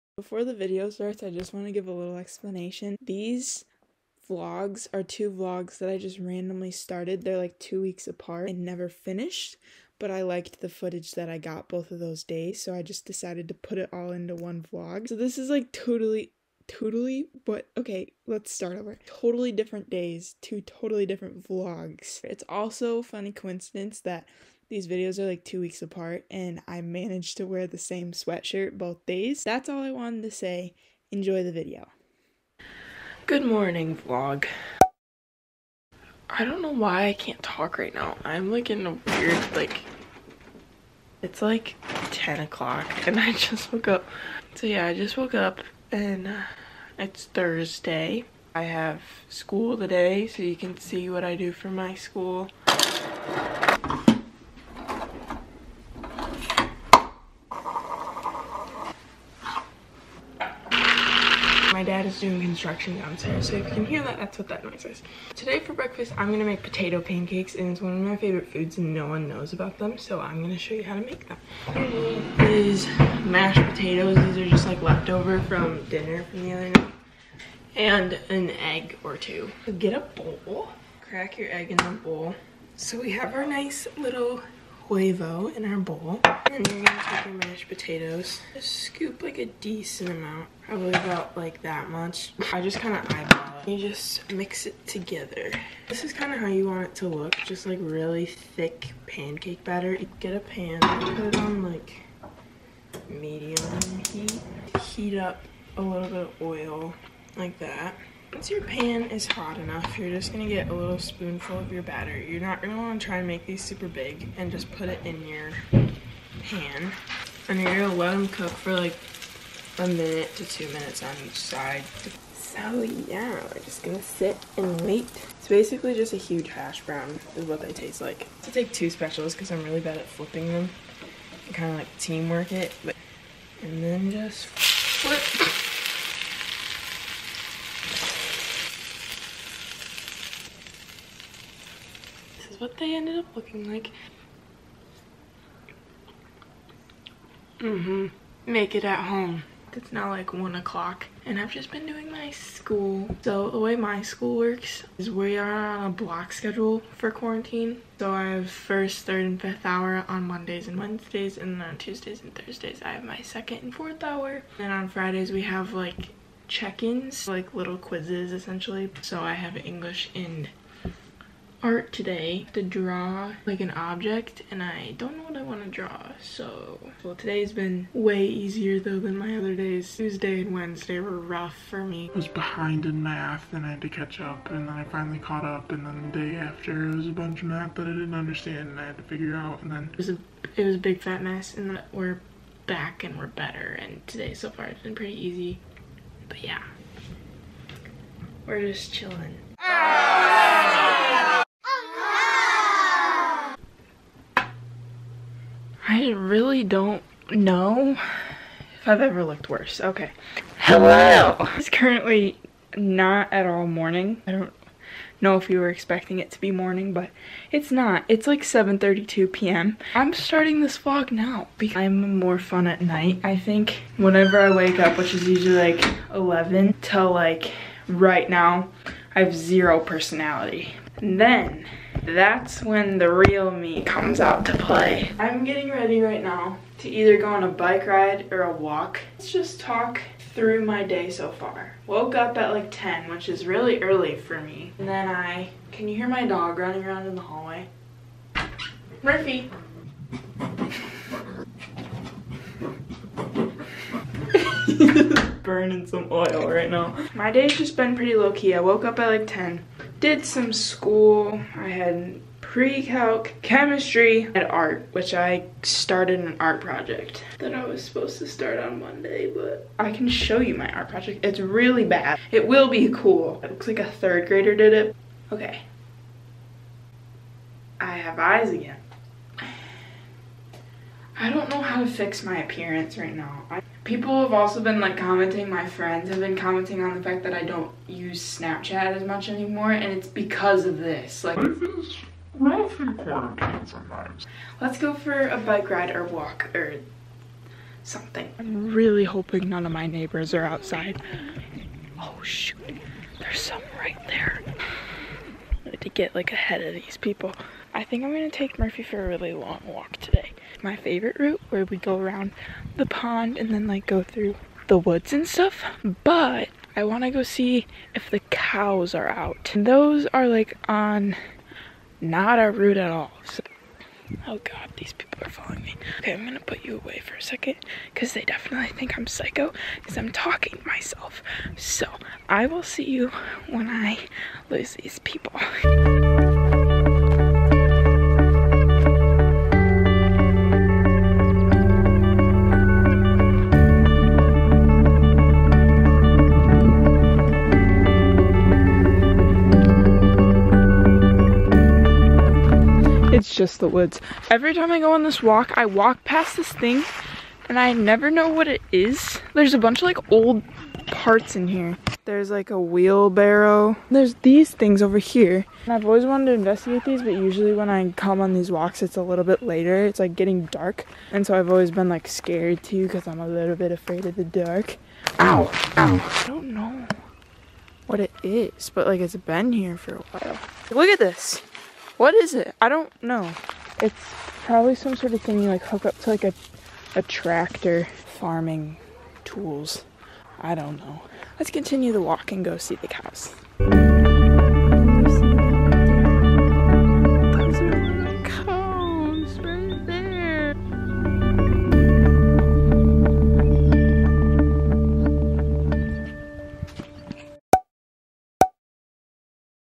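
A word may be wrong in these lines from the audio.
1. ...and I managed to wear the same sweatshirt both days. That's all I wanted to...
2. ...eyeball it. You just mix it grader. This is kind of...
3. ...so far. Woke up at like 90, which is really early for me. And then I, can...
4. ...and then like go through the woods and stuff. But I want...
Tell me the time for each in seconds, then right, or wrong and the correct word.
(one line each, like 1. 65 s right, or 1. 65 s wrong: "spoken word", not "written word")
1. 26 s right
2. 93 s wrong: "together", not "grader"
3. 241 s wrong: "10", not "90"
4. 313 s right.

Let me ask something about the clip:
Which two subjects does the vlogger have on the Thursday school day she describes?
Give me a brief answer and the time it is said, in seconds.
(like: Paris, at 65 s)
English and art, at 169 s.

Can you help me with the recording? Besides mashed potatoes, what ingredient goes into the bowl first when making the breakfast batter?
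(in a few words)
an egg.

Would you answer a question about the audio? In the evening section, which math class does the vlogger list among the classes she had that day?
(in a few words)
pre-calc.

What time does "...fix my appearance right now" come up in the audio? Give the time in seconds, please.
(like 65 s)
281 s.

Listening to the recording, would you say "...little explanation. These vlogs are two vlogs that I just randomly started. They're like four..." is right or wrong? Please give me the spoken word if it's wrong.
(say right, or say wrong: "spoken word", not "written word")
wrong: "two", not "four".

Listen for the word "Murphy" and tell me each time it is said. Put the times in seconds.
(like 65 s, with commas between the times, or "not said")
249 s, 308 s.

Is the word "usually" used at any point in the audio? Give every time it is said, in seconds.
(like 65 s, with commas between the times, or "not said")
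225 s, 367 s.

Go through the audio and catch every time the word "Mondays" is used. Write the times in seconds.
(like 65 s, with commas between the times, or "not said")
160 s, 268 s.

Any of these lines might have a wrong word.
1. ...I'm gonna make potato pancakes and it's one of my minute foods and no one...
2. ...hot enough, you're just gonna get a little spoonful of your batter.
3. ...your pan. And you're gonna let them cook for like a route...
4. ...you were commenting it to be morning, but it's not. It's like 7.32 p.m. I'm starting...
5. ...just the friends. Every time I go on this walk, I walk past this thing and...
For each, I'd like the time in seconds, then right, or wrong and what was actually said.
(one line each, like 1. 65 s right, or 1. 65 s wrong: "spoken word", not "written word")
1. 66 s wrong: "favorite", not "minute"
2. 109 s right
3. 115 s wrong: "minute", not "route"
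4. 215 s wrong: "expecting", not "commenting"
5. 353 s wrong: "woods", not "friends".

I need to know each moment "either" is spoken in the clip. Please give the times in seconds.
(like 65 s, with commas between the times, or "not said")
236 s.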